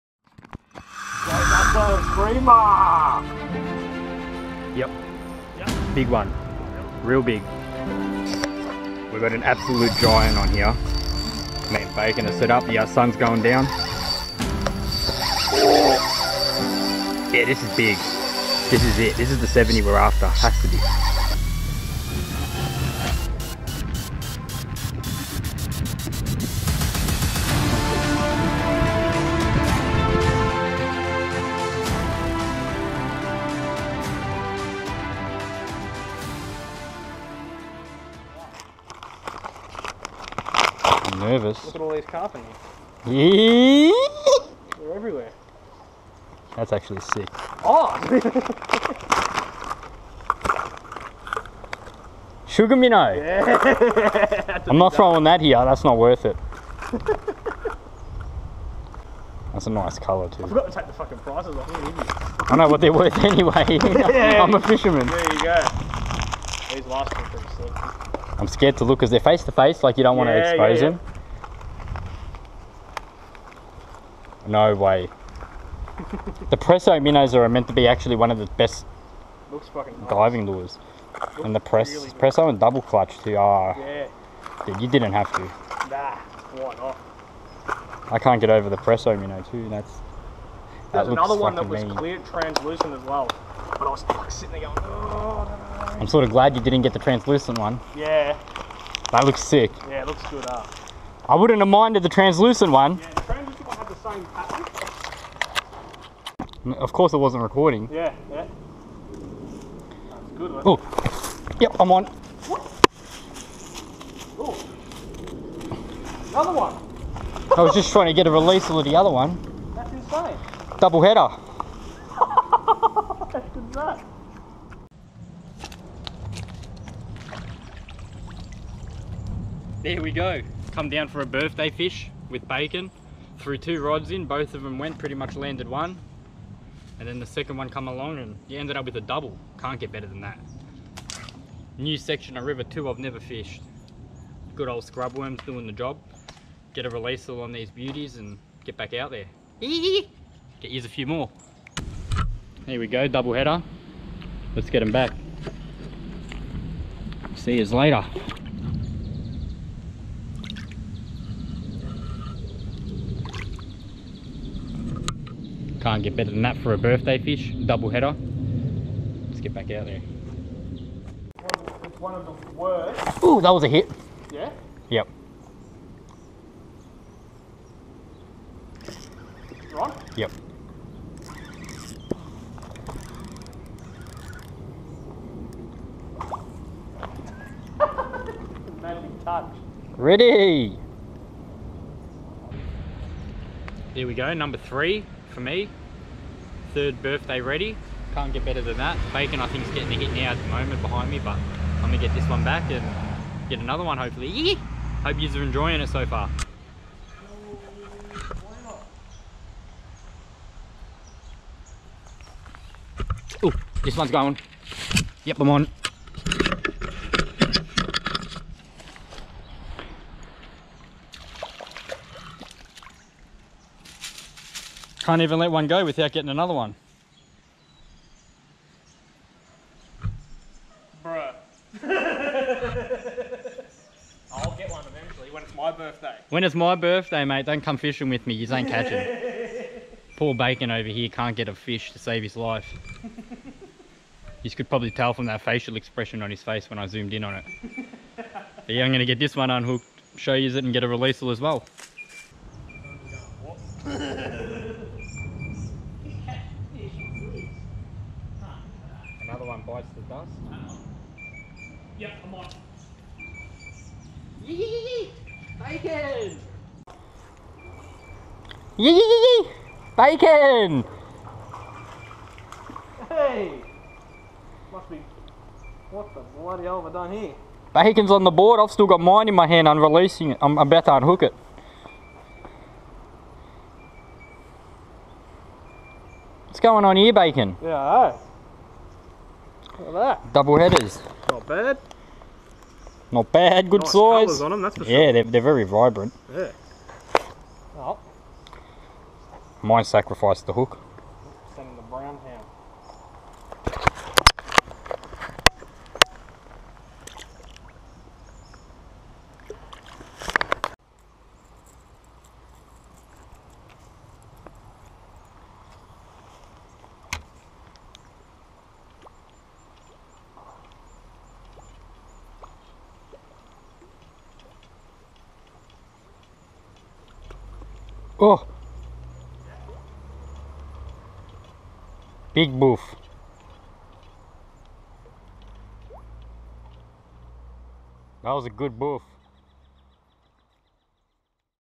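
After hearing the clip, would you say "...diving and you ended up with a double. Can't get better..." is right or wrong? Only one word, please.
wrong.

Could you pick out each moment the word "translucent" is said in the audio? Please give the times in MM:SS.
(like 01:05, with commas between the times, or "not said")
01:32, 01:36, 01:42.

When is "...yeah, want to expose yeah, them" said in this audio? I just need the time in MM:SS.
01:10.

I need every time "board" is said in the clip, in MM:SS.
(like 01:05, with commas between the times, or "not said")
04:38.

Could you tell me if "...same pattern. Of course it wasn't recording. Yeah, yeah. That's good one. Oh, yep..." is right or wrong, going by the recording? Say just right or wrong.
right.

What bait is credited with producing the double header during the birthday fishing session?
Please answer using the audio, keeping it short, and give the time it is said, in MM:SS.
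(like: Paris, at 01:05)
Scrub worms, at 02:24.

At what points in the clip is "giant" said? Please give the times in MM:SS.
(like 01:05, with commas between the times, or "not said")
00:09.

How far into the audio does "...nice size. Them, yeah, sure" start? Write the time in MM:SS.
04:53.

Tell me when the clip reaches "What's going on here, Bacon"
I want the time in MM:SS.
04:46.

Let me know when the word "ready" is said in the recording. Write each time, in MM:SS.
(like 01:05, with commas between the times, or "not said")
03:09, 03:17.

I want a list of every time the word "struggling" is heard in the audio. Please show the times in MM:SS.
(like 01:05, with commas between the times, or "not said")
not said.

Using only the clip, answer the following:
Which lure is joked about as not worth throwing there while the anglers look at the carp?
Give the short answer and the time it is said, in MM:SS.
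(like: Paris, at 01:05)
Sugar minnow, at 00:52.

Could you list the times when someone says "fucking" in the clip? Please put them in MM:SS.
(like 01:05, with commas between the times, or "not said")
01:00, 01:19.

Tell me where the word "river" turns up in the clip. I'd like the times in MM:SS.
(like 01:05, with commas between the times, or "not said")
02:22.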